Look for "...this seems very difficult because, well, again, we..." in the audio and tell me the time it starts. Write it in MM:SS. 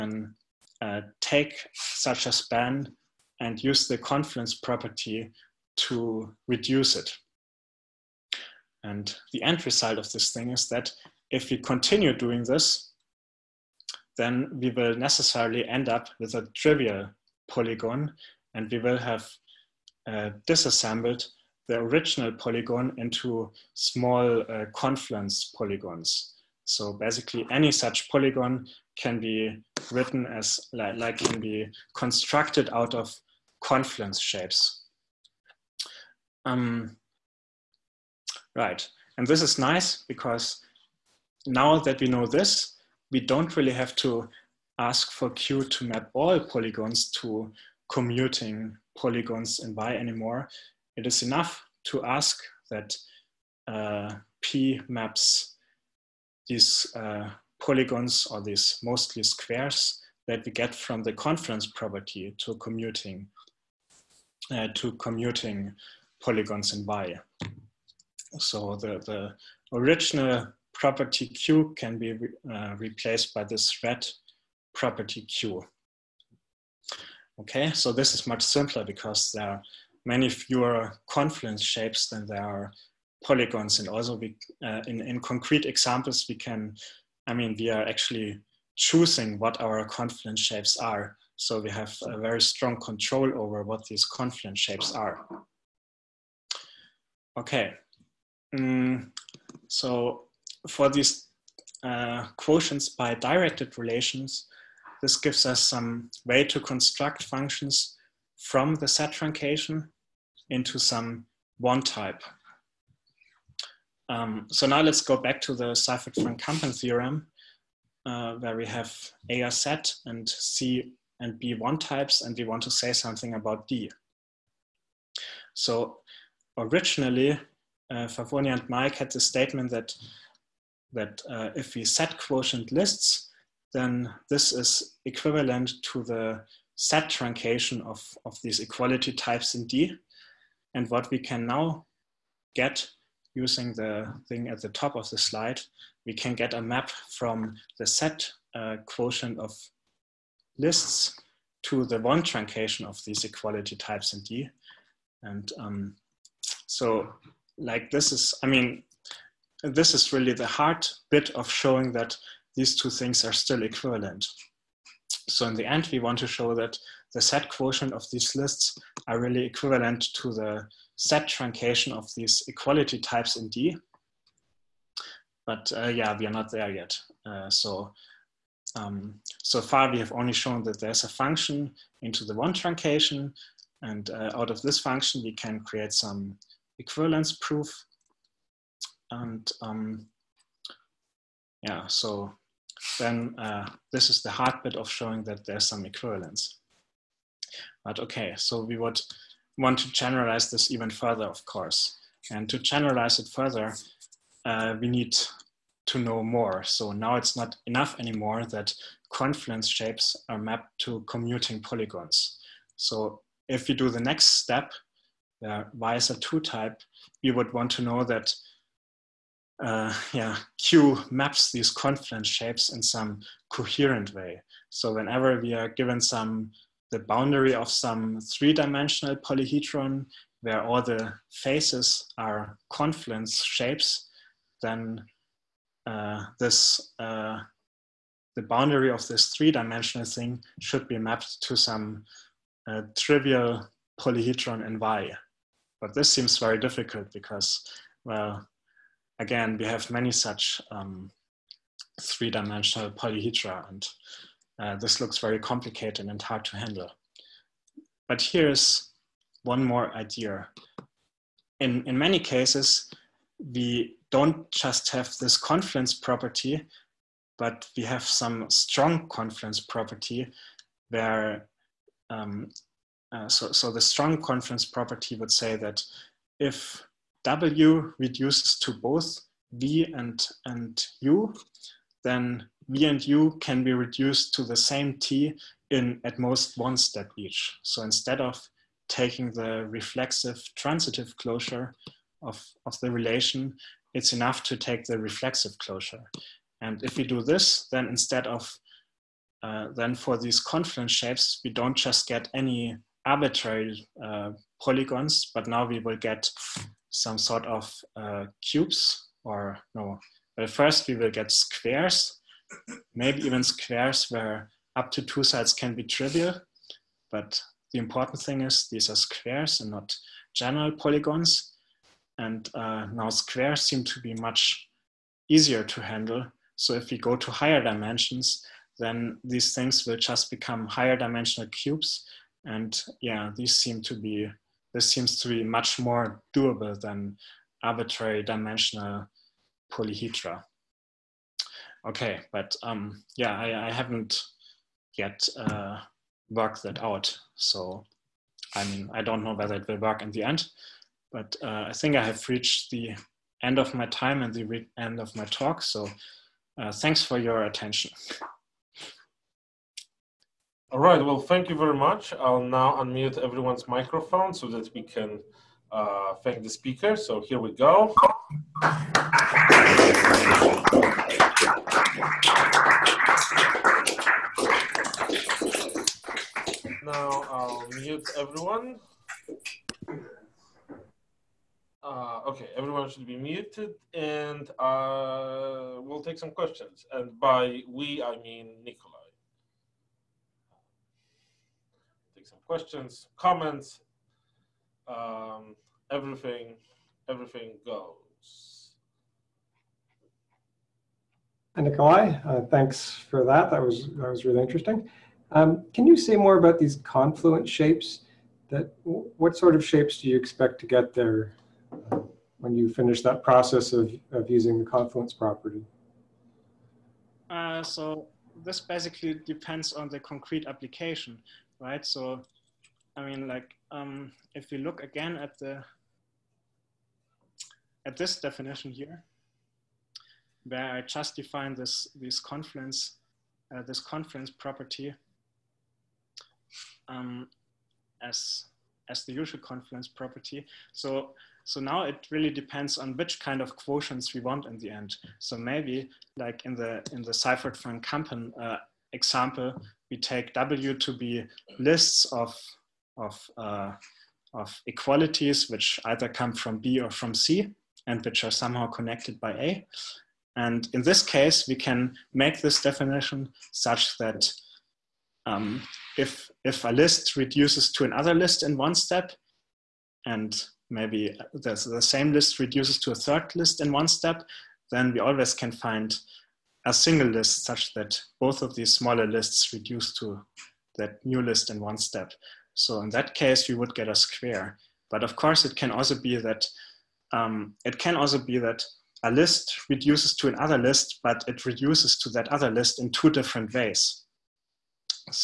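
04:05.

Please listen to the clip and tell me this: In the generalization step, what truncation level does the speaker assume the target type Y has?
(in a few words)
Two type.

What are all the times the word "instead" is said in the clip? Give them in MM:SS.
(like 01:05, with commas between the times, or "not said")
04:47, 04:57.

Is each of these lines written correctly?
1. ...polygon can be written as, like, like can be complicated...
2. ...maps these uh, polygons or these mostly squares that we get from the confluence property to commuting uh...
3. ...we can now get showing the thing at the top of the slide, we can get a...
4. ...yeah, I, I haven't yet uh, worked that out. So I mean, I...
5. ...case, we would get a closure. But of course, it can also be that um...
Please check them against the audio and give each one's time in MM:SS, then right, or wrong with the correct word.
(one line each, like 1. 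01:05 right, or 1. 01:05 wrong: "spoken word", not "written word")
1. 00:28 wrong: "constructed", not "complicated"
2. 00:54 right
3. 02:21 wrong: "using", not "showing"
4. 05:43 right
5. 08:03 wrong: "square", not "closure".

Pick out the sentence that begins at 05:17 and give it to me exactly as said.
But the important thing is these are squares and not general polygons.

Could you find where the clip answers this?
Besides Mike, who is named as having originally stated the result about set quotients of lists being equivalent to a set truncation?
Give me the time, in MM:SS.
02:08.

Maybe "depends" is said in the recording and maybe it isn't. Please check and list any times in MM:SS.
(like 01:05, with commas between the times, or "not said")
06:59, 07:22.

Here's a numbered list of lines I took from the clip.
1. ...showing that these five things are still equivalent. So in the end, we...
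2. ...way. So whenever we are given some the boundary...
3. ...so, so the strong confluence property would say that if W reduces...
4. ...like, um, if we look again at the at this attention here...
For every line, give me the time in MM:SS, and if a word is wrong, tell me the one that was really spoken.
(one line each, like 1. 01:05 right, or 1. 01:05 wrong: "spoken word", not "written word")
1. 02:41 wrong: "two", not "five"
2. 03:44 right
3. 04:33 right
4. 07:03 wrong: "definition", not "attention".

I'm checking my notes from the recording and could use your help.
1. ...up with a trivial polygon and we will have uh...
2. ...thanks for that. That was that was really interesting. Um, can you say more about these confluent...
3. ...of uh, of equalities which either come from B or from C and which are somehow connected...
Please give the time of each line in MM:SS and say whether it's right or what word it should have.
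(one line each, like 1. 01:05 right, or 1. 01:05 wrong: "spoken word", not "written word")
1. 00:15 right
2. 06:42 right
3. 07:32 right.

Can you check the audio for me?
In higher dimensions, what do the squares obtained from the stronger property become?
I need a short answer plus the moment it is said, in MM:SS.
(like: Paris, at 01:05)
Higher dimensional cubes, at 05:30.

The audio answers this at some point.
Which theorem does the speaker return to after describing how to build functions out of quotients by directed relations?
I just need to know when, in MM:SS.
01:55.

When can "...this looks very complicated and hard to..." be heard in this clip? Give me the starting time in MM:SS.
04:14.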